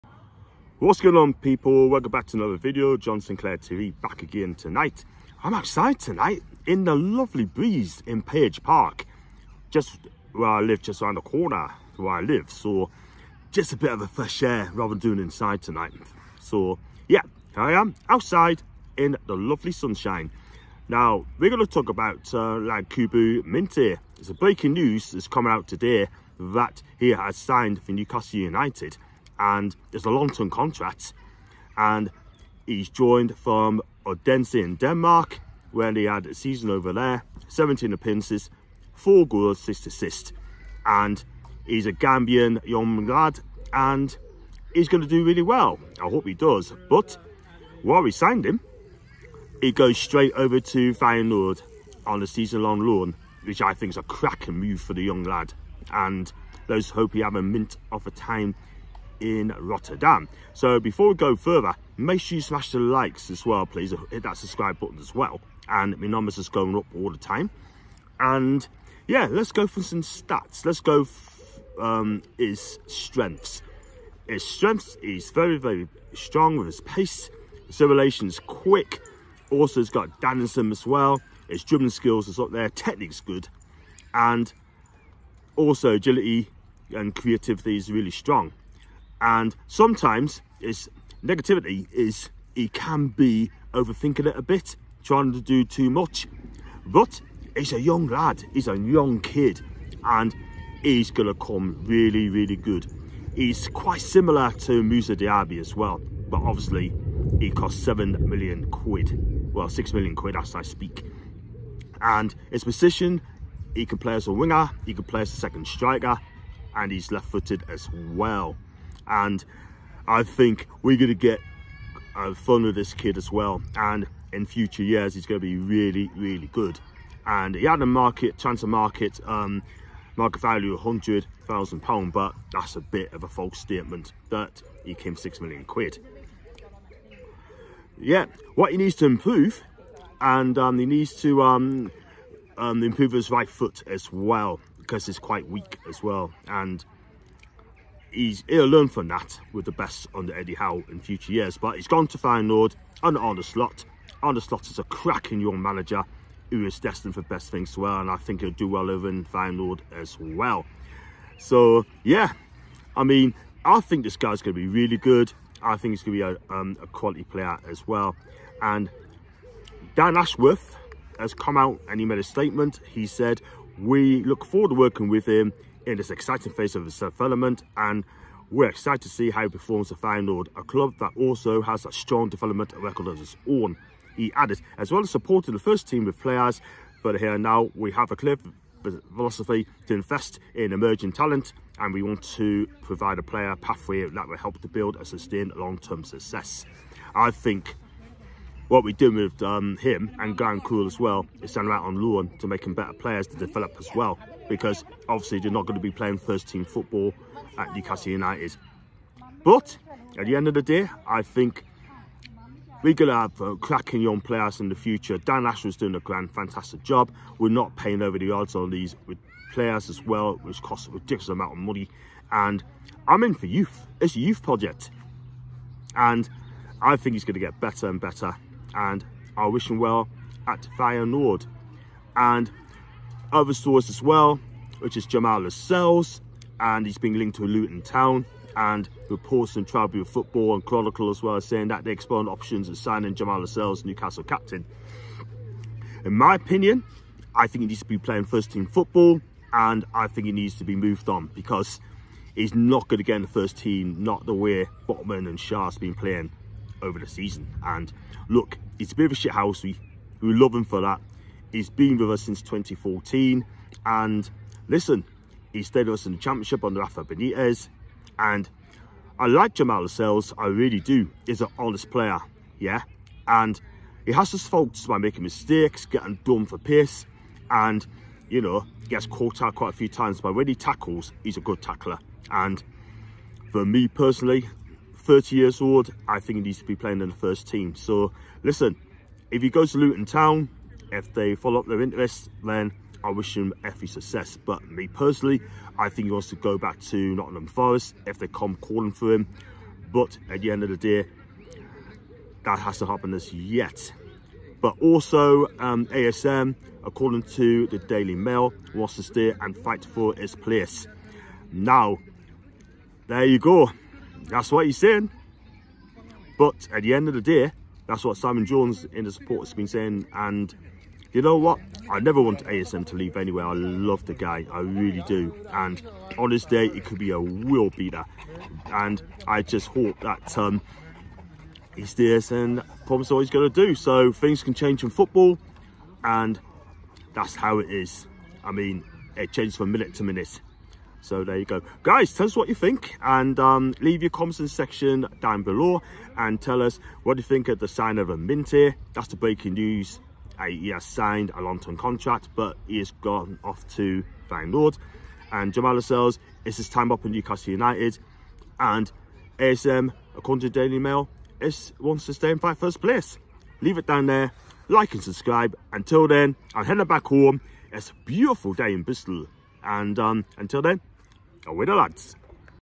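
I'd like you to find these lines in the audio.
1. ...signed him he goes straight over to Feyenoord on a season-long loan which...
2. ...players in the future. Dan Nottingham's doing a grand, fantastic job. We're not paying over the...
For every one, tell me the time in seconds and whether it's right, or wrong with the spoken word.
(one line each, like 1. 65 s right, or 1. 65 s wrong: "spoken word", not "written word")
1. 48 s right
2. 214 s wrong: "Ashworth", not "Nottingham".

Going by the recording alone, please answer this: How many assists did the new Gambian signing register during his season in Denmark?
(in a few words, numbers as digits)
6.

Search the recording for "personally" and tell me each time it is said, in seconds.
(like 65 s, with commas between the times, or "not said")
283 s, 294 s.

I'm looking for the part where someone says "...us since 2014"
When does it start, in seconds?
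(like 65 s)
262 s.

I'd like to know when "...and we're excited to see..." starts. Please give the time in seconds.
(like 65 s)
177 s.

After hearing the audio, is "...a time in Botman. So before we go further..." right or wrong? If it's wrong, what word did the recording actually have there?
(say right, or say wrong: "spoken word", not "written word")
wrong: "Rotterdam", not "Botman".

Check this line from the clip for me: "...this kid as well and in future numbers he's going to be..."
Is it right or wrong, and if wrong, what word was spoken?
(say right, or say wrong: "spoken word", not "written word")
wrong: "years", not "numbers".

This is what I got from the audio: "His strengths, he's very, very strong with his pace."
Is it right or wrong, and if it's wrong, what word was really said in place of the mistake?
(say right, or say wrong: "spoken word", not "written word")
right.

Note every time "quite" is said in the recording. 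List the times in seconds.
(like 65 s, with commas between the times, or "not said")
103 s, 145 s, 279 s.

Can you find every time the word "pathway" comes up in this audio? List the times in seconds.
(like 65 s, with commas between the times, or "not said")
193 s.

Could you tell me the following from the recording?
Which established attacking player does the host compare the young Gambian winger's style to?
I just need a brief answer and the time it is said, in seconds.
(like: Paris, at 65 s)
Moussa Diaby, at 104 s.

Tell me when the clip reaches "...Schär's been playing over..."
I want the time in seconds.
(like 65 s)
255 s.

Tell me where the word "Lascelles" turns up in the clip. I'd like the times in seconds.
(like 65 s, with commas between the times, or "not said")
235 s, 243 s, 269 s, 355 s.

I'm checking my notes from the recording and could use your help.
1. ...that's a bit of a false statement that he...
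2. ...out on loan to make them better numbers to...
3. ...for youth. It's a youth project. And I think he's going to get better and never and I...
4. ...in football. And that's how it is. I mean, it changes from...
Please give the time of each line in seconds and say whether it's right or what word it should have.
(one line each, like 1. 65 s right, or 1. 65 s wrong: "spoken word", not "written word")
1. 132 s right
2. 201 s wrong: "players", not "numbers"
3. 223 s wrong: "better", not "never"
4. 334 s right.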